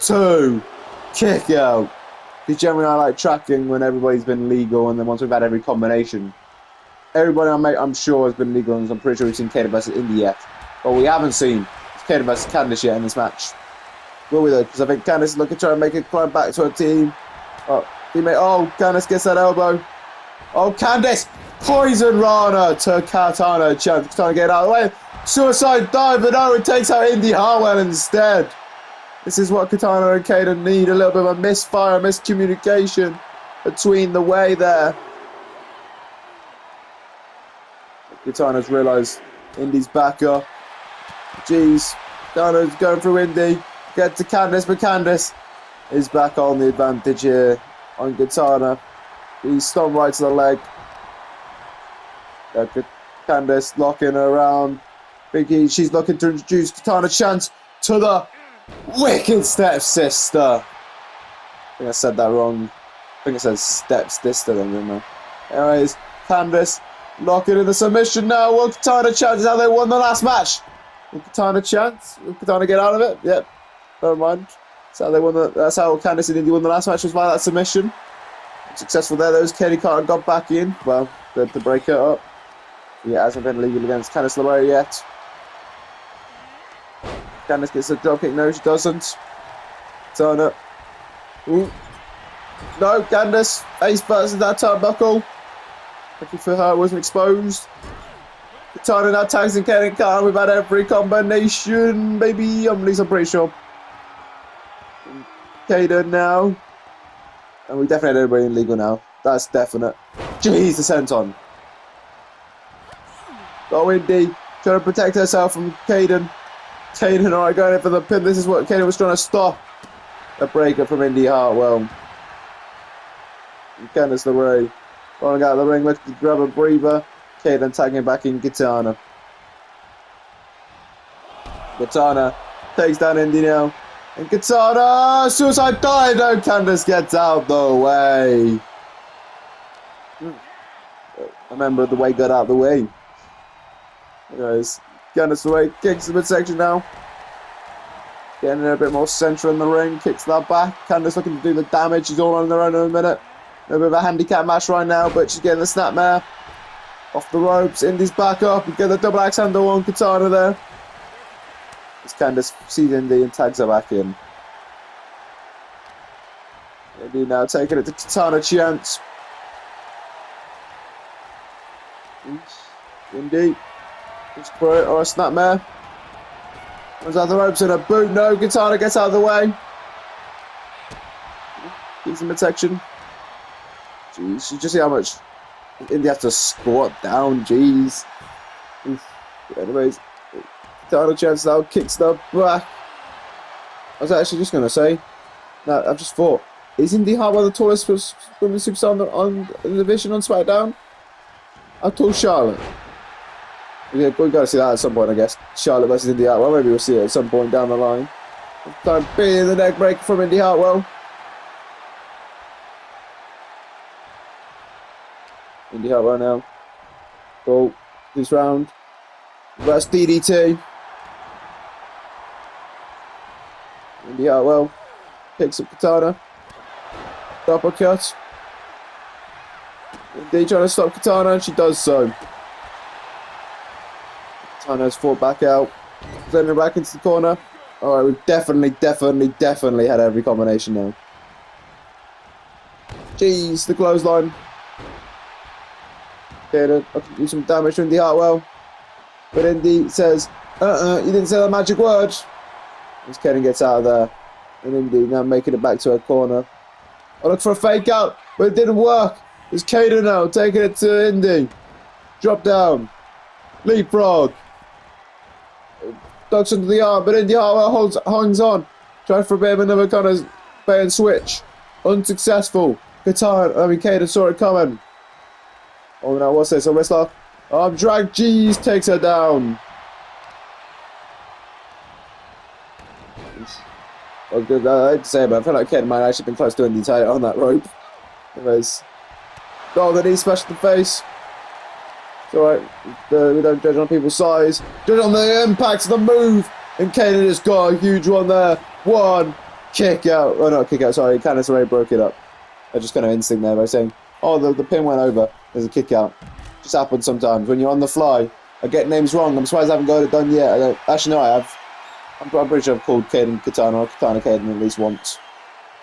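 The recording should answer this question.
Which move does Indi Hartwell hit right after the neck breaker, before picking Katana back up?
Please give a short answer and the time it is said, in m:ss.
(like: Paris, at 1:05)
DDT, at 3:39.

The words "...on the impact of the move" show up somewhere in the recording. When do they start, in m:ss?
4:54.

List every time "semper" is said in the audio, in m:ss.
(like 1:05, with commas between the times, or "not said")
not said.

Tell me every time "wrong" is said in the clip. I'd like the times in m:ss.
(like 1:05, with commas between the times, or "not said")
1:02, 5:09.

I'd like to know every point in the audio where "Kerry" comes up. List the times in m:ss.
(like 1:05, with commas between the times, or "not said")
1:19.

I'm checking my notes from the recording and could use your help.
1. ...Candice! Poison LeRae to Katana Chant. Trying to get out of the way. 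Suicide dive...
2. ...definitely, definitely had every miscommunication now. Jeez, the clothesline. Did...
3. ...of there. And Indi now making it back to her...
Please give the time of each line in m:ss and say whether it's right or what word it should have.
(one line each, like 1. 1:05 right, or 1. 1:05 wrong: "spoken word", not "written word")
1. 0:20 wrong: "Rana", not "LeRae"
2. 3:58 wrong: "combination", not "miscommunication"
3. 4:13 right.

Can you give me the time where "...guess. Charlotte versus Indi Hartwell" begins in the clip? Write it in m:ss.
3:25.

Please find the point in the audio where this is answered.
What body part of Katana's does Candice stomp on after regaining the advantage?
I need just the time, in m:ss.
0:50.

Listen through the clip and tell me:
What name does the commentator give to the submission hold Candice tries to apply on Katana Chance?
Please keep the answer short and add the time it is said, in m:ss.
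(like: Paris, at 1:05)
wicked stepsister, at 0:58.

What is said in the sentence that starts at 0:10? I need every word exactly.
But we haven't seen Kayden versus Candice yet in this match.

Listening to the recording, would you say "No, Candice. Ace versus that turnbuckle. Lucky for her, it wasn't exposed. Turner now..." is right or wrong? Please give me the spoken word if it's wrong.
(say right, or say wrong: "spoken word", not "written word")
right.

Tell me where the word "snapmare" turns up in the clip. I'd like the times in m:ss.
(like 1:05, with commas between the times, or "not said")
2:35, 2:55.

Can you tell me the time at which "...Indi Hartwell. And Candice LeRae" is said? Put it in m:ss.
2:01.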